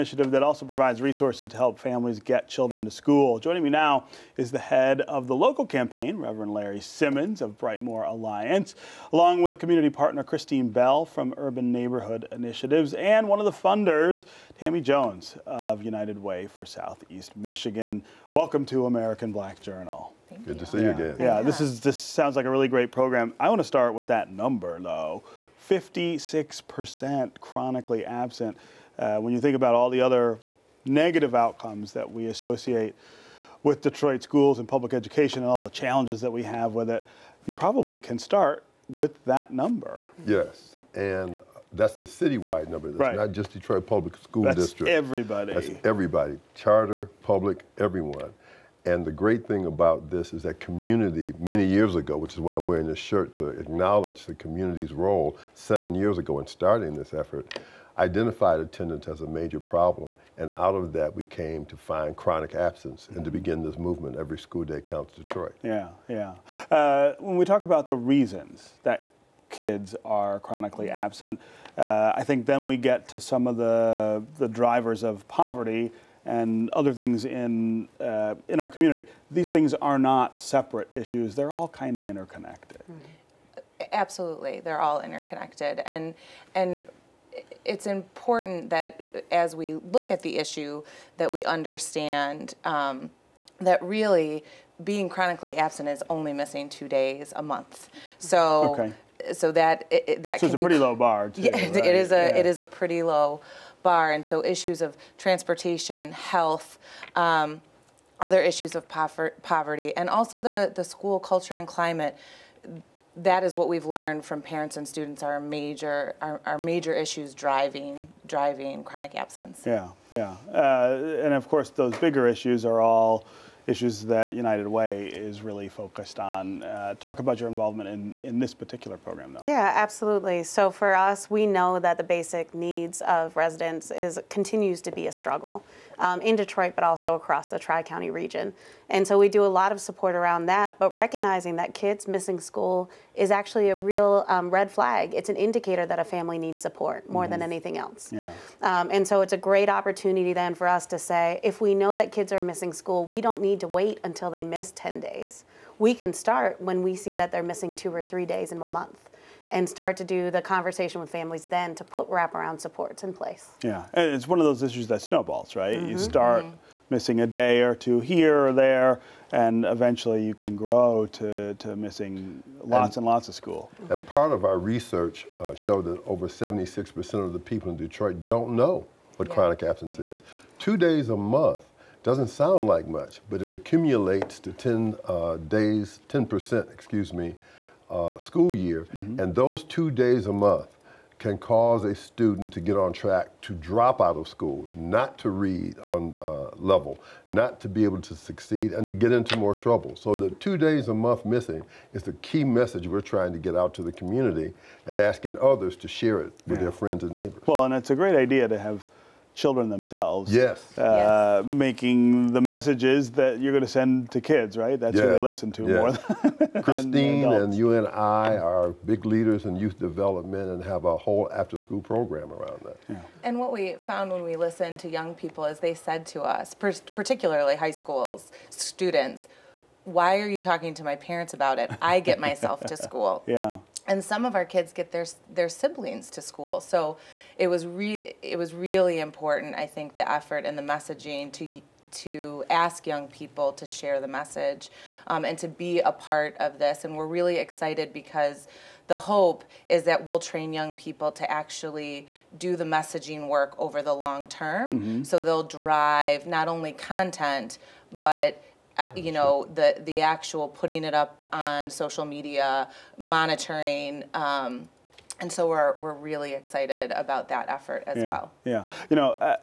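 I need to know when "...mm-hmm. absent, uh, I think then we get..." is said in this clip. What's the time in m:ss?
1:10.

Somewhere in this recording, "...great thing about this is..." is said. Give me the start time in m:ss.
0:49.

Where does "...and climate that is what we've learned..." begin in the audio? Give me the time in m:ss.
1:51.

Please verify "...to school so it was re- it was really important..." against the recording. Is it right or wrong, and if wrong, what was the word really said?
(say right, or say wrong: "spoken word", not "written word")
right.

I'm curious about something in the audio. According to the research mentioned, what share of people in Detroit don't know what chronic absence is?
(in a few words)
over 76%.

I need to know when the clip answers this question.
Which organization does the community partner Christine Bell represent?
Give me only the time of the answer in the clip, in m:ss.
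0:11.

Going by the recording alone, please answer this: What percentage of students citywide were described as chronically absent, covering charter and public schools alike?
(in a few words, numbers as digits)
56%.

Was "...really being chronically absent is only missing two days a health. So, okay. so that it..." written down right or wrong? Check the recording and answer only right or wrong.
wrong.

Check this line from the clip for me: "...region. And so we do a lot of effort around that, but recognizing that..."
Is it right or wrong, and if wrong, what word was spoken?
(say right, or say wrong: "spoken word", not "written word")
wrong: "support", not "effort".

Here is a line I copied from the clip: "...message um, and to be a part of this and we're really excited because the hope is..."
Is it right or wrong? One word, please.
right.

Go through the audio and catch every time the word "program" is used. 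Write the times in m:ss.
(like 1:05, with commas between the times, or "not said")
0:22, 2:08, 3:41.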